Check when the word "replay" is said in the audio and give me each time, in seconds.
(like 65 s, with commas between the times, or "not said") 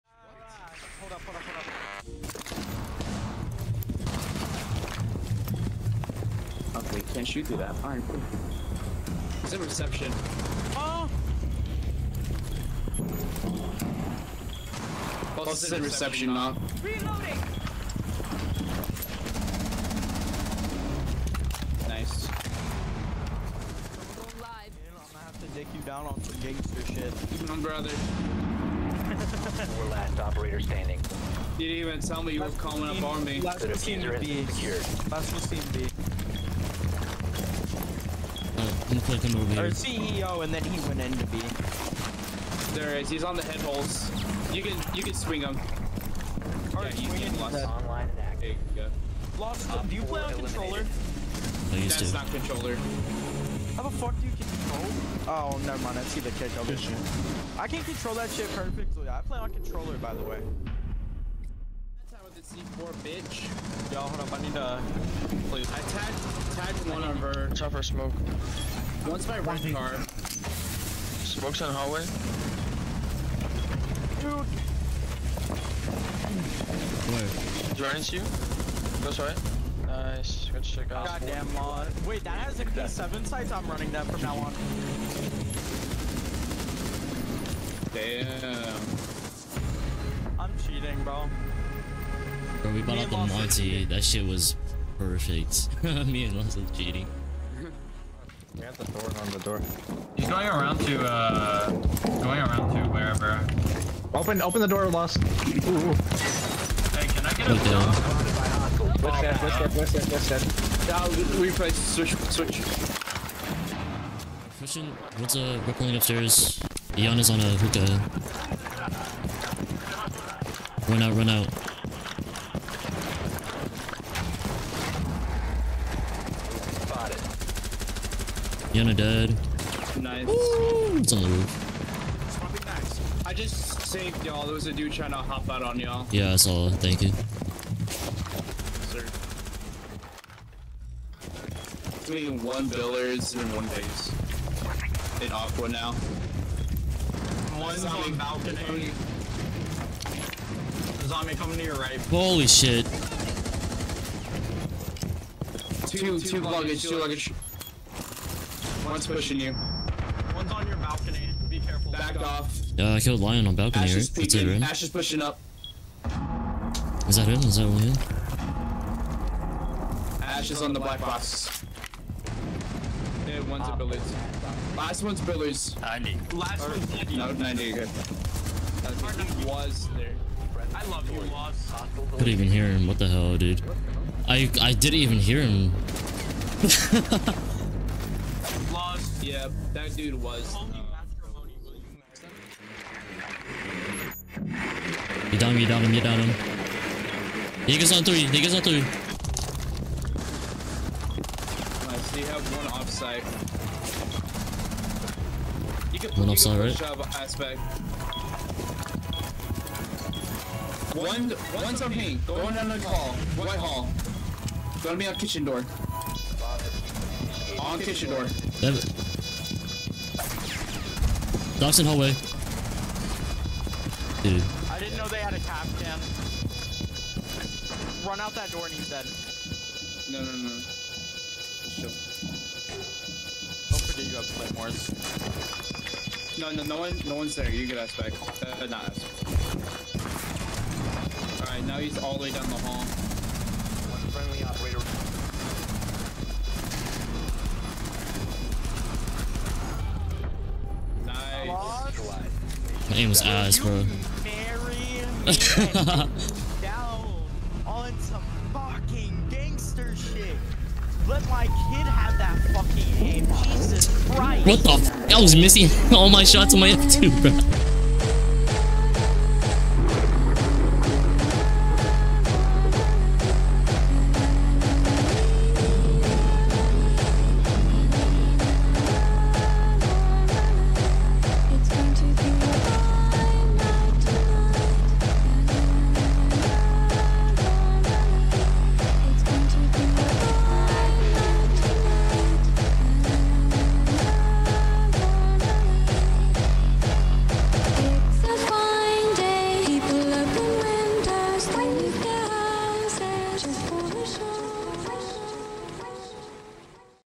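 111 s.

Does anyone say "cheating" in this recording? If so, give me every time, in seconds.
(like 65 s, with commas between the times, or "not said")
90 s, 96 s.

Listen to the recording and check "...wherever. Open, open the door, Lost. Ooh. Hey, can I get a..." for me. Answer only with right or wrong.
right.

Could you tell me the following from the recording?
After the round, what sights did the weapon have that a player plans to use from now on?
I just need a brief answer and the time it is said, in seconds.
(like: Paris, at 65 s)
P7 sights, at 82 s.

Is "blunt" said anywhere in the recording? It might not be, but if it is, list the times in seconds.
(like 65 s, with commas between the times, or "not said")
not said.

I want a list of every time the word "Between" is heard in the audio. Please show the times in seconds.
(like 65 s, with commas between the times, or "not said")
141 s.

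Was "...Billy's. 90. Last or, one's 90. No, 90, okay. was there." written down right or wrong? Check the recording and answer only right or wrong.
right.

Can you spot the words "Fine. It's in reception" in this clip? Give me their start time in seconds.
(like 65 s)
7 s.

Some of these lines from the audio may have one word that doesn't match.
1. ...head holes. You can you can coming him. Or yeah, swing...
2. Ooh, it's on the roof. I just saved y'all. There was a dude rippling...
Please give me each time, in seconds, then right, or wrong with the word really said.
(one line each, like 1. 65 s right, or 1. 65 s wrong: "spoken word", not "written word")
1. 43 s wrong: "swing", not "coming"
2. 130 s wrong: "trying", not "rippling".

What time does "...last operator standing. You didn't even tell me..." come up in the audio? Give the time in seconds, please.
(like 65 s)
29 s.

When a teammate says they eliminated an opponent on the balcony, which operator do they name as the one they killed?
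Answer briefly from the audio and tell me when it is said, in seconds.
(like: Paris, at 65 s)
Lion, at 163 s.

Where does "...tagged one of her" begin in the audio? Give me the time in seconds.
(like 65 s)
66 s.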